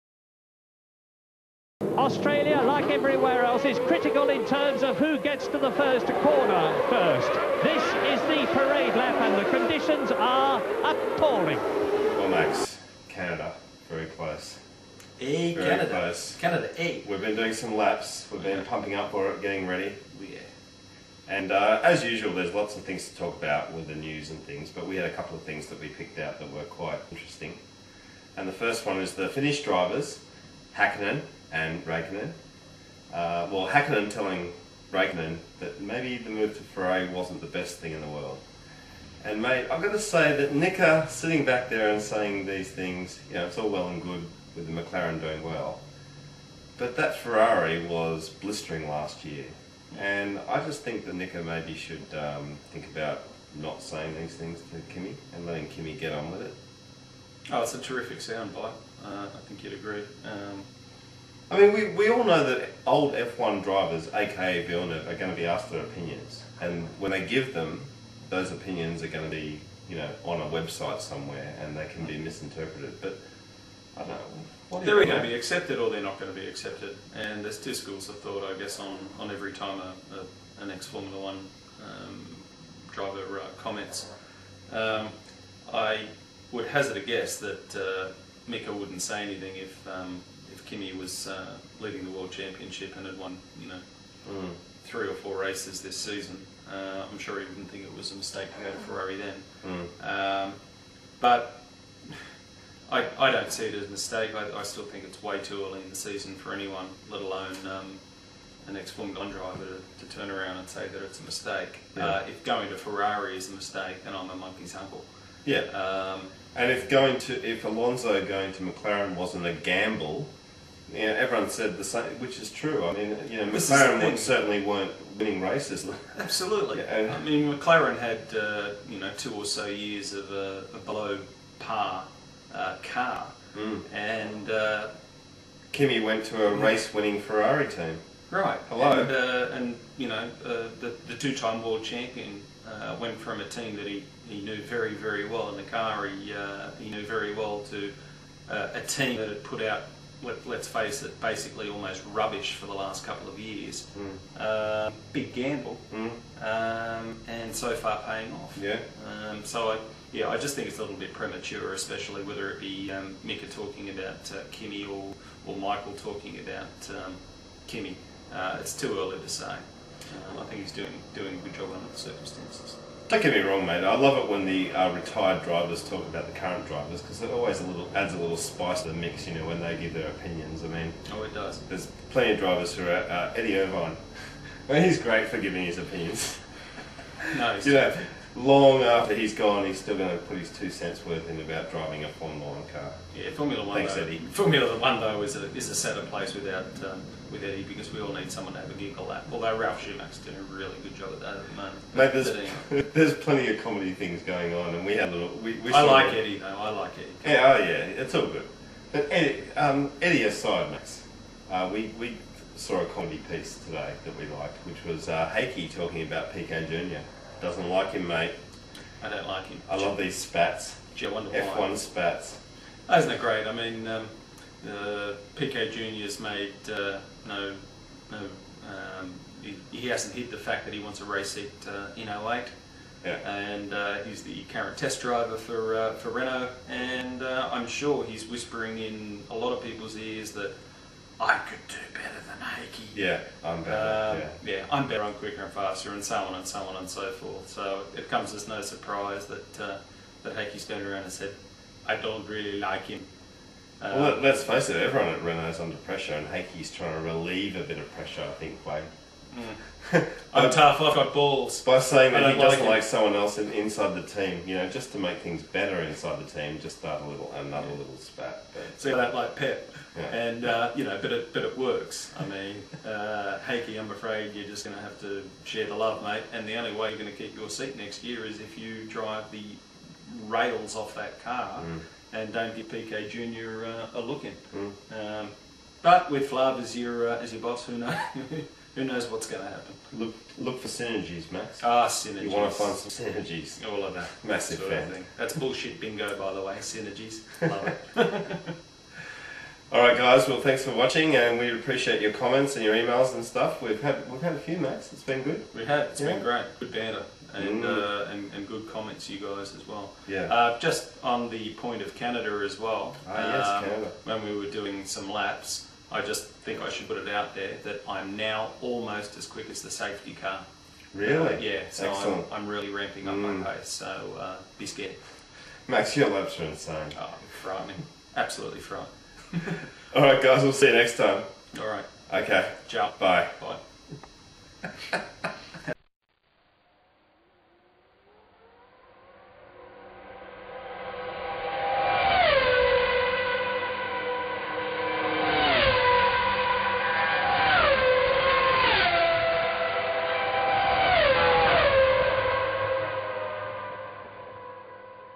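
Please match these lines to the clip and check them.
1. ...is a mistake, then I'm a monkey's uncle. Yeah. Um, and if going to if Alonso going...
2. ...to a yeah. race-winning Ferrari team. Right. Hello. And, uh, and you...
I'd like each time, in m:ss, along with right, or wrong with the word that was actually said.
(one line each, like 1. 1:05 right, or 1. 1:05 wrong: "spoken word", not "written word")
1. 1:53 right
2. 2:16 right.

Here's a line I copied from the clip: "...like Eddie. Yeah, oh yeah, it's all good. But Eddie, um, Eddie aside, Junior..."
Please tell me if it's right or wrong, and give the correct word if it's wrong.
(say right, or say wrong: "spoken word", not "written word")
wrong: "Max", not "Junior".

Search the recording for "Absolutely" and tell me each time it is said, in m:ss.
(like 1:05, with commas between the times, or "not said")
2:06, 5:28.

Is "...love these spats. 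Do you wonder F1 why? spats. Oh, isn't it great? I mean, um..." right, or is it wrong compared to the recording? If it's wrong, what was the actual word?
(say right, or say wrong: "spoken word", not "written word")
right.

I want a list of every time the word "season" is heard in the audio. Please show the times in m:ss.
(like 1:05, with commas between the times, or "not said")
1:35, 1:45.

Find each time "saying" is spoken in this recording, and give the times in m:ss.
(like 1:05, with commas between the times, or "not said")
0:42, 0:53, 4:21.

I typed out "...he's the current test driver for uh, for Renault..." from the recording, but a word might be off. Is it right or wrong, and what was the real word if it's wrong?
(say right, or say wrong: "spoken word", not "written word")
right.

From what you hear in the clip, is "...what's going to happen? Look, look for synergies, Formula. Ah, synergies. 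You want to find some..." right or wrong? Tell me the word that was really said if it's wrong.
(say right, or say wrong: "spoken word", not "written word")
wrong: "Max", not "Formula".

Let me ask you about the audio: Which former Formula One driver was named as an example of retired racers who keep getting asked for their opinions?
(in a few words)
Villeneuve.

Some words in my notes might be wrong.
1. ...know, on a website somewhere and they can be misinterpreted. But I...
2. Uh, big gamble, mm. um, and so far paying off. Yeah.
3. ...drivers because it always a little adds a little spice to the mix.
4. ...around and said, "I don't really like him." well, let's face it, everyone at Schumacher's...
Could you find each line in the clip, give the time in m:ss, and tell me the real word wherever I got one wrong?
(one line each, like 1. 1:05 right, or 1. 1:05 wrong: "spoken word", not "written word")
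1. 1:09 right
2. 2:34 right
3. 2:56 right
4. 4:10 wrong: "Renault", not "Schumacher".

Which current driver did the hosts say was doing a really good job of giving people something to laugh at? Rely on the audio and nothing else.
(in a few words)
Ralf Schumacher.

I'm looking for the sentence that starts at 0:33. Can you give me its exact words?
Uh, well, Hakkinen telling Raikkonen that maybe the move to Ferrari wasn't the best thing in the world.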